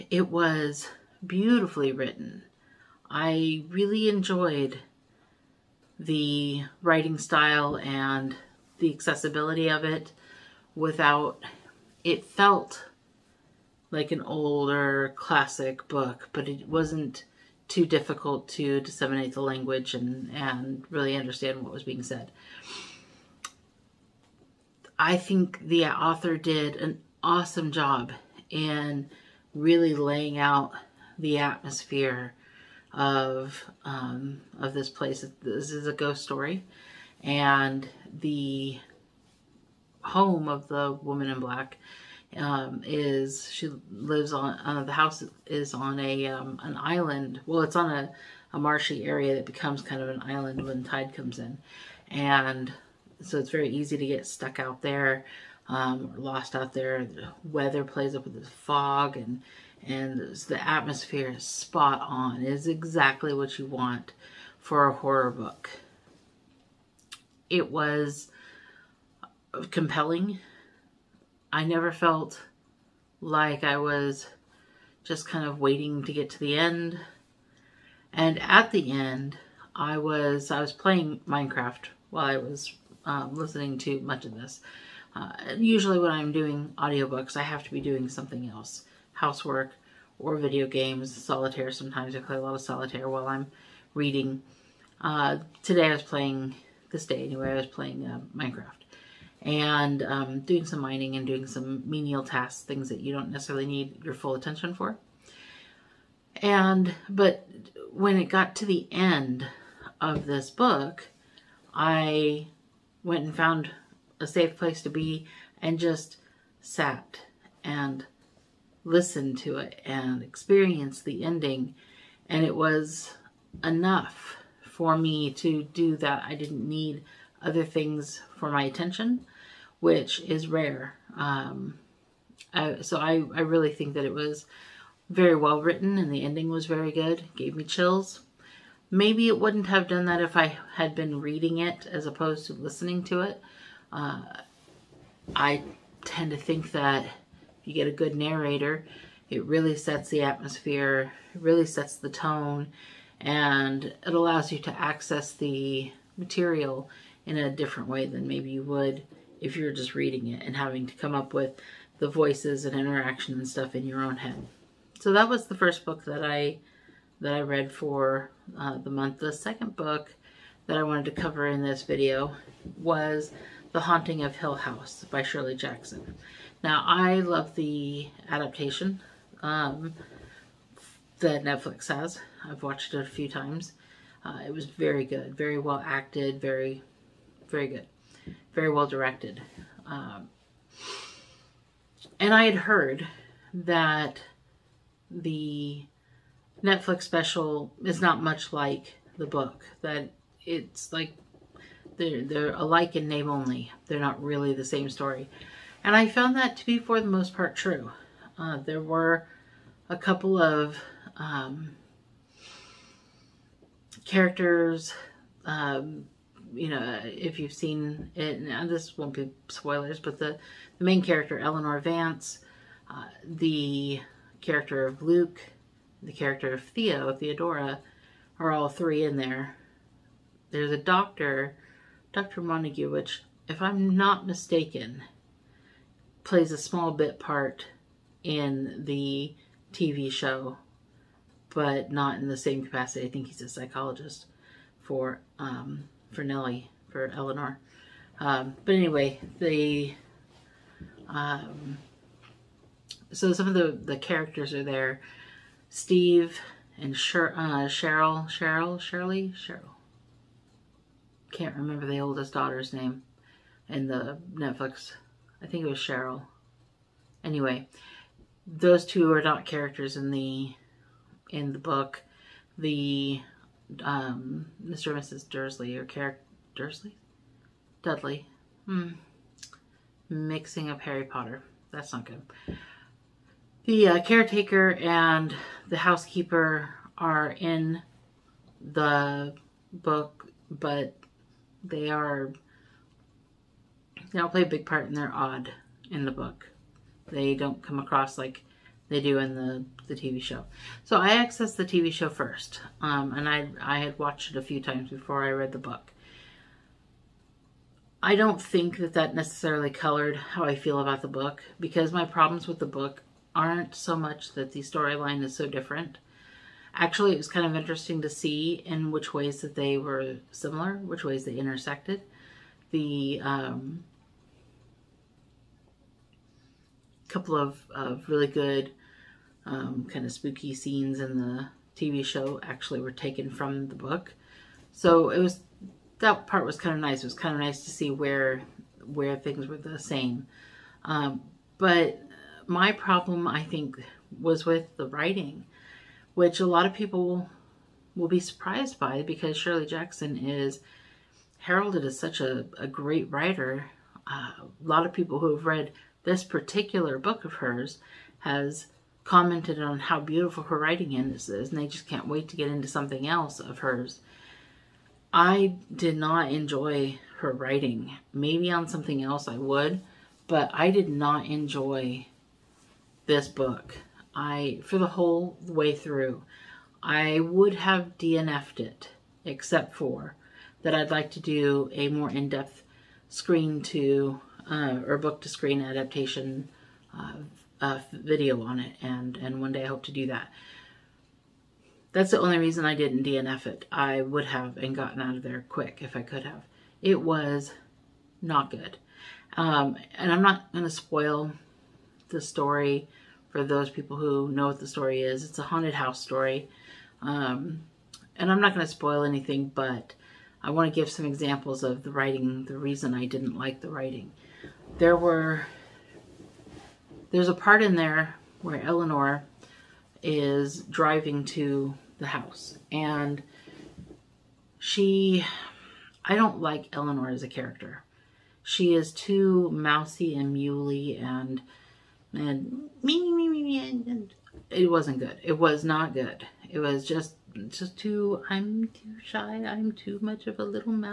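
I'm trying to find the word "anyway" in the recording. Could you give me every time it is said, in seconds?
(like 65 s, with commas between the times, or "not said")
97 s, 248 s, 267 s.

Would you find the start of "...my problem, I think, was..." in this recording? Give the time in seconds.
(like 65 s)
342 s.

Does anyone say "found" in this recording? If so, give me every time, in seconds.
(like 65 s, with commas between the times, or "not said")
113 s, 206 s.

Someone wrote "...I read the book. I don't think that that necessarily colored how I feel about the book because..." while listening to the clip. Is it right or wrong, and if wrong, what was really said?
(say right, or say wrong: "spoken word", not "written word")
right.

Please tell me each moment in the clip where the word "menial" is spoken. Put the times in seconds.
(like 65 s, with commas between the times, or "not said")
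101 s.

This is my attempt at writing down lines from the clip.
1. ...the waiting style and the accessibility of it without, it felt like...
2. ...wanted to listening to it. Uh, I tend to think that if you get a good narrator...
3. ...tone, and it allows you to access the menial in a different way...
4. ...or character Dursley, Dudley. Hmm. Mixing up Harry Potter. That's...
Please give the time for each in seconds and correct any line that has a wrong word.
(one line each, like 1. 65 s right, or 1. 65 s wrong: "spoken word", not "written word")
1. 5 s wrong: "writing", not "waiting"
2. 142 s wrong: "opposed", not "wanted"
3. 152 s wrong: "material", not "menial"
4. 275 s right.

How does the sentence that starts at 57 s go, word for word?
The weather plays up with the fog and and the atmosphere is spot on.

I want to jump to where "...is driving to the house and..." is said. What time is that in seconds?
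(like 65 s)
420 s.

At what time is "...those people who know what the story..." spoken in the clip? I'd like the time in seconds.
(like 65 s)
403 s.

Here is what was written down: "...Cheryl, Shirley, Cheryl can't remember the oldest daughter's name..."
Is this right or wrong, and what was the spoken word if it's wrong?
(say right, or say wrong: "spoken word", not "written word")
right.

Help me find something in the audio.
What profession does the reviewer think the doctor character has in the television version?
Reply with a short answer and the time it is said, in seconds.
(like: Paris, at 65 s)
psychologist, at 243 s.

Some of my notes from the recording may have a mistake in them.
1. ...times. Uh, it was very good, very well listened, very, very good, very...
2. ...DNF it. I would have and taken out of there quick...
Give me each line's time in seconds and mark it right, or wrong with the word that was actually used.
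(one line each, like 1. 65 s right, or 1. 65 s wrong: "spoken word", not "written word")
1. 183 s wrong: "acted", not "listened"
2. 393 s wrong: "gotten", not "taken".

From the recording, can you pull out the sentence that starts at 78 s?
And at the end, I was I was playing Minecraft while I was um, listening to much of this.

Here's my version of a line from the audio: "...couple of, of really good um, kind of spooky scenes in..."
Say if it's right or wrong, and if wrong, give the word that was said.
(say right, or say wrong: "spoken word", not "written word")
right.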